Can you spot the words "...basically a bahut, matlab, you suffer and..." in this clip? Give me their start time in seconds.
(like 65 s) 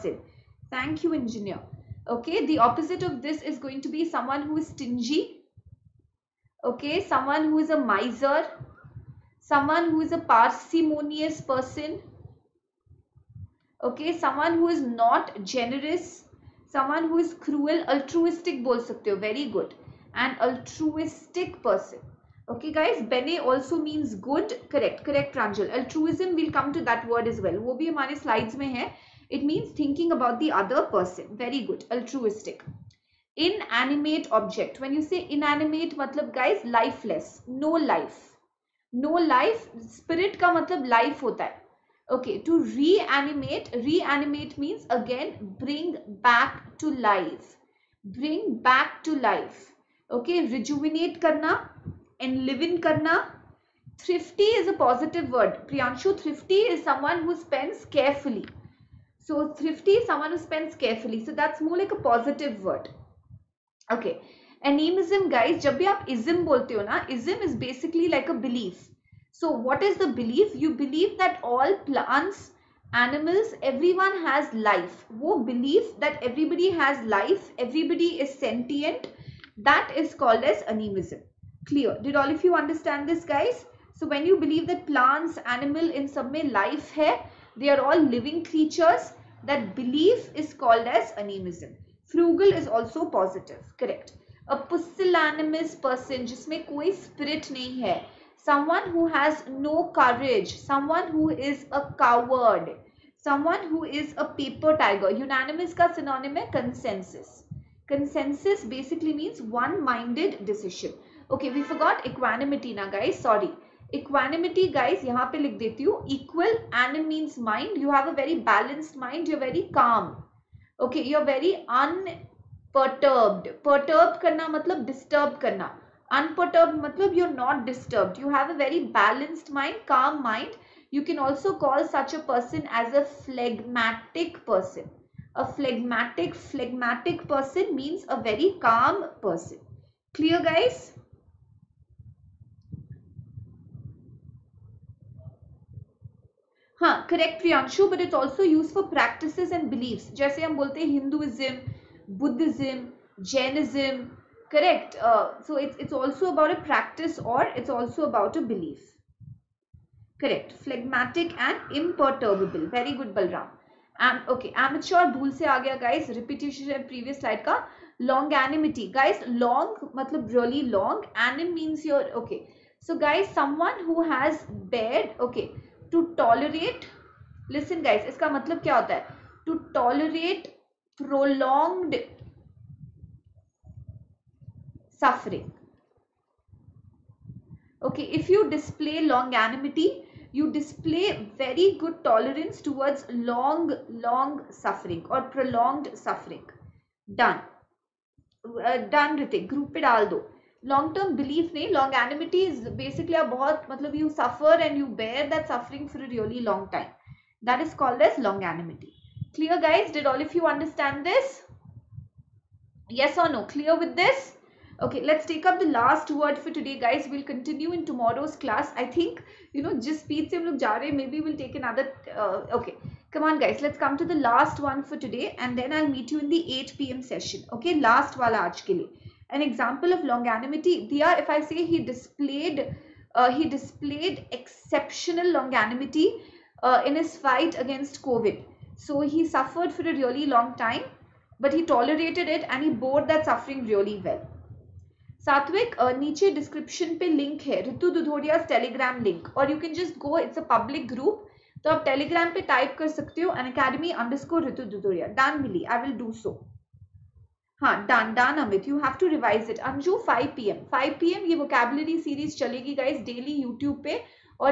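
202 s.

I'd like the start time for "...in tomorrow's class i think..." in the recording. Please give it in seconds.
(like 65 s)
217 s.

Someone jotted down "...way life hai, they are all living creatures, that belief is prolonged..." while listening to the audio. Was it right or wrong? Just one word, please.
wrong.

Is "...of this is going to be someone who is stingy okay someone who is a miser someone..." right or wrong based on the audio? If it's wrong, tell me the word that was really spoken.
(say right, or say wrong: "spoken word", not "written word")
right.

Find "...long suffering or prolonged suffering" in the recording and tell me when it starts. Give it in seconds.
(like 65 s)
194 s.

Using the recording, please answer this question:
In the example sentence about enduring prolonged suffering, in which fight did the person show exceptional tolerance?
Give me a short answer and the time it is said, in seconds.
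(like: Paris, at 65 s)
Covid, at 238 s.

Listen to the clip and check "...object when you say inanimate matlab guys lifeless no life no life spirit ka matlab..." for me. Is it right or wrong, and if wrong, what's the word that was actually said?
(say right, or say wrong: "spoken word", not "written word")
right.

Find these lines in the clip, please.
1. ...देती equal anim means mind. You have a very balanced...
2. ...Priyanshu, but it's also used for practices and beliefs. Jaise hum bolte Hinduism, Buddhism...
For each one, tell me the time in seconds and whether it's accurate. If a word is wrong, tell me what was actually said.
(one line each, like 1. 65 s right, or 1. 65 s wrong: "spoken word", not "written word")
1. 115 s right
2. 147 s right.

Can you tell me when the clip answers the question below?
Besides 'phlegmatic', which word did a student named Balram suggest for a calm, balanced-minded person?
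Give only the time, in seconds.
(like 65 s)
161 s.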